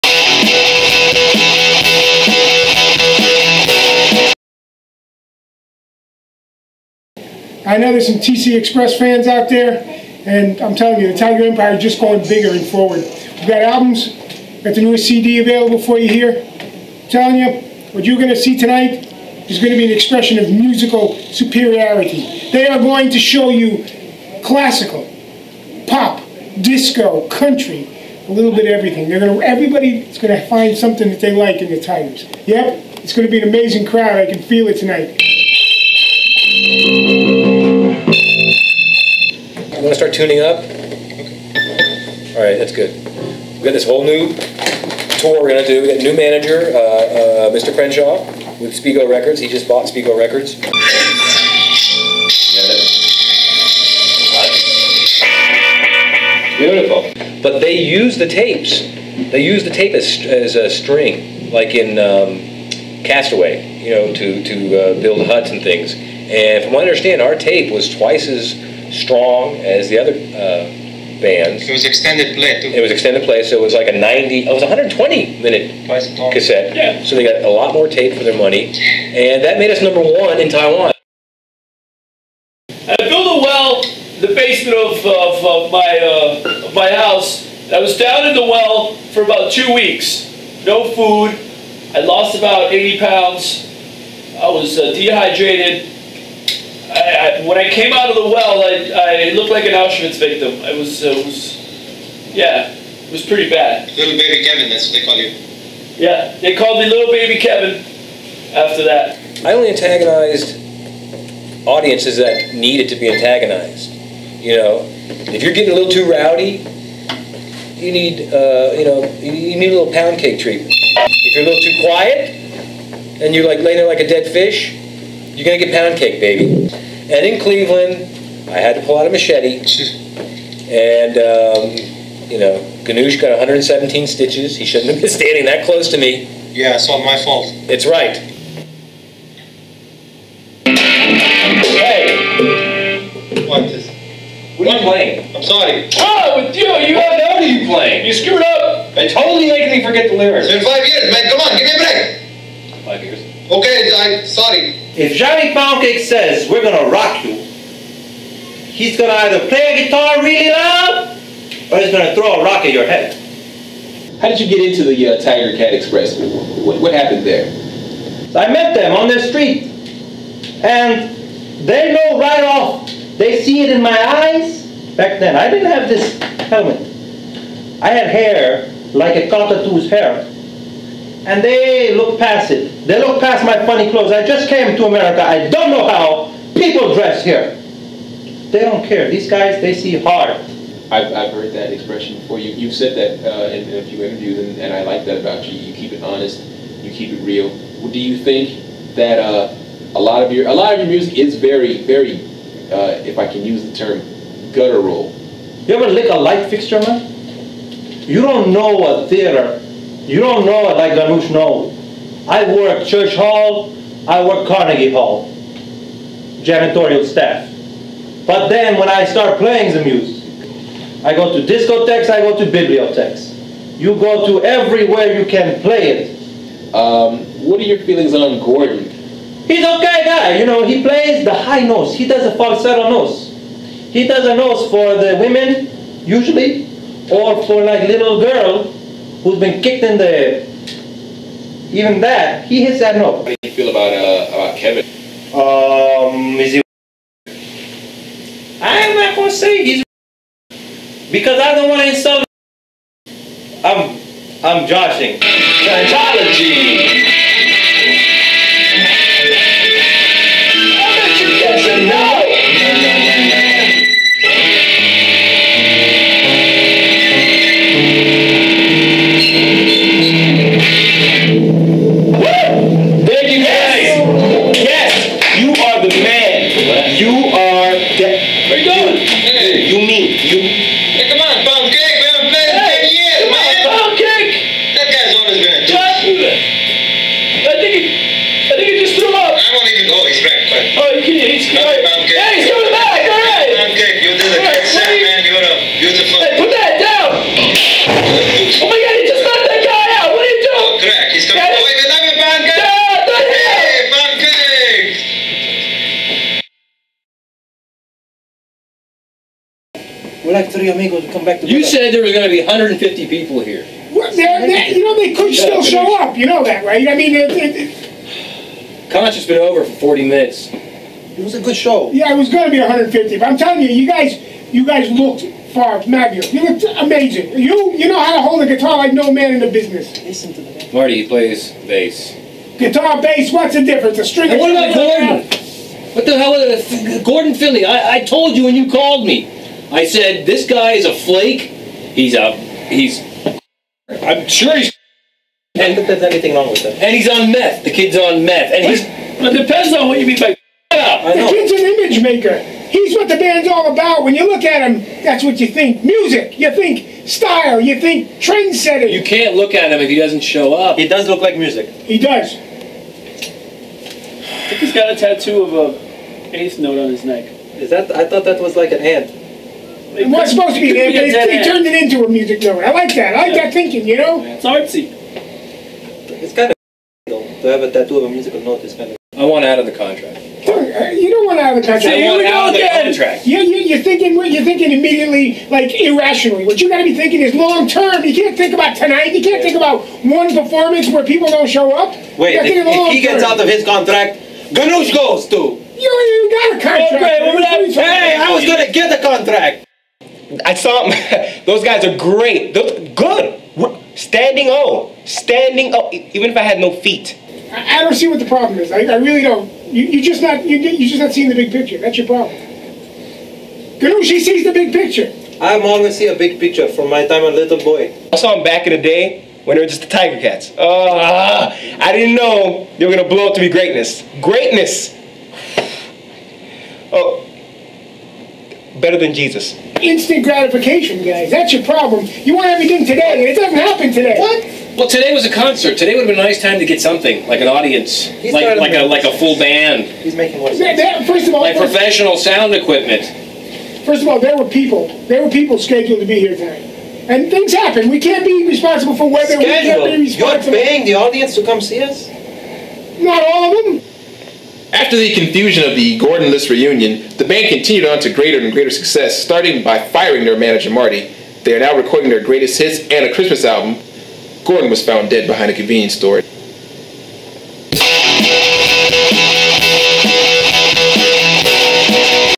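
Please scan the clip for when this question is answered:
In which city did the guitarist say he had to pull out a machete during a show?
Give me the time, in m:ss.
2:07.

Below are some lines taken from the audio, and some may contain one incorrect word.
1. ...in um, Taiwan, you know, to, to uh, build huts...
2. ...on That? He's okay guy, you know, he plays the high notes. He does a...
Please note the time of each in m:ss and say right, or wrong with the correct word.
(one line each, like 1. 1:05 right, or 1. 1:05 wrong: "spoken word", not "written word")
1. 1:01 wrong: "Castaway", not "Taiwan"
2. 3:48 wrong: "Gordon", not "That".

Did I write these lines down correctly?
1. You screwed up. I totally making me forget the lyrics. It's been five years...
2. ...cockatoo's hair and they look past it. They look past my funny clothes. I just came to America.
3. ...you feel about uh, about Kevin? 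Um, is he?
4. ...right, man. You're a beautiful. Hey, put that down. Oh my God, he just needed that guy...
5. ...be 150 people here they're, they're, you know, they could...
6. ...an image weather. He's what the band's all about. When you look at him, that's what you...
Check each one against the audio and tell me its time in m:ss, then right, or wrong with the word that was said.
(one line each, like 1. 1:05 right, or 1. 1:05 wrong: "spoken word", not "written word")
1. 2:28 right
2. 2:59 right
3. 4:03 right
4. 4:54 wrong: "knocked", not "needed"
5. 5:12 right
6. 5:51 wrong: "maker", not "weather".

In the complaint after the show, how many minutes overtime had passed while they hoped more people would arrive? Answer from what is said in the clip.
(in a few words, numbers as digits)
40.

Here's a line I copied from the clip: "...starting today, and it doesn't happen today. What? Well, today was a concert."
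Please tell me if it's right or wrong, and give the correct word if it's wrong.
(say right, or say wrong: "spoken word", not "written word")
wrong: "everything", not "starting".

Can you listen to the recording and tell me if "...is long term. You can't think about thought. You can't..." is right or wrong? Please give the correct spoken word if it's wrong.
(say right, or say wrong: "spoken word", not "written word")
wrong: "tonight", not "thought".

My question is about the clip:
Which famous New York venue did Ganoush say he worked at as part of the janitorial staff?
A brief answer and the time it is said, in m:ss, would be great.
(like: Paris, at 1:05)
Carnegie Hall, at 3:34.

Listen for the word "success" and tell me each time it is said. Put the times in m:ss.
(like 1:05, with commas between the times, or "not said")
7:38.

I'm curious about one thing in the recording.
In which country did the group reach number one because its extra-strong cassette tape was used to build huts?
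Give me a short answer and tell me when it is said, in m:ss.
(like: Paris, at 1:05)
Taiwan, at 1:20.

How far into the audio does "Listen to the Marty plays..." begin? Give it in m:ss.
5:30.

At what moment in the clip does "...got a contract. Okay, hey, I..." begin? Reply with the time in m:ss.
6:36.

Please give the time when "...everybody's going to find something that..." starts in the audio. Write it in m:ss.
0:29.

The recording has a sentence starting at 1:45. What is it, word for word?
Yeah, they called me little baby Kevin after that.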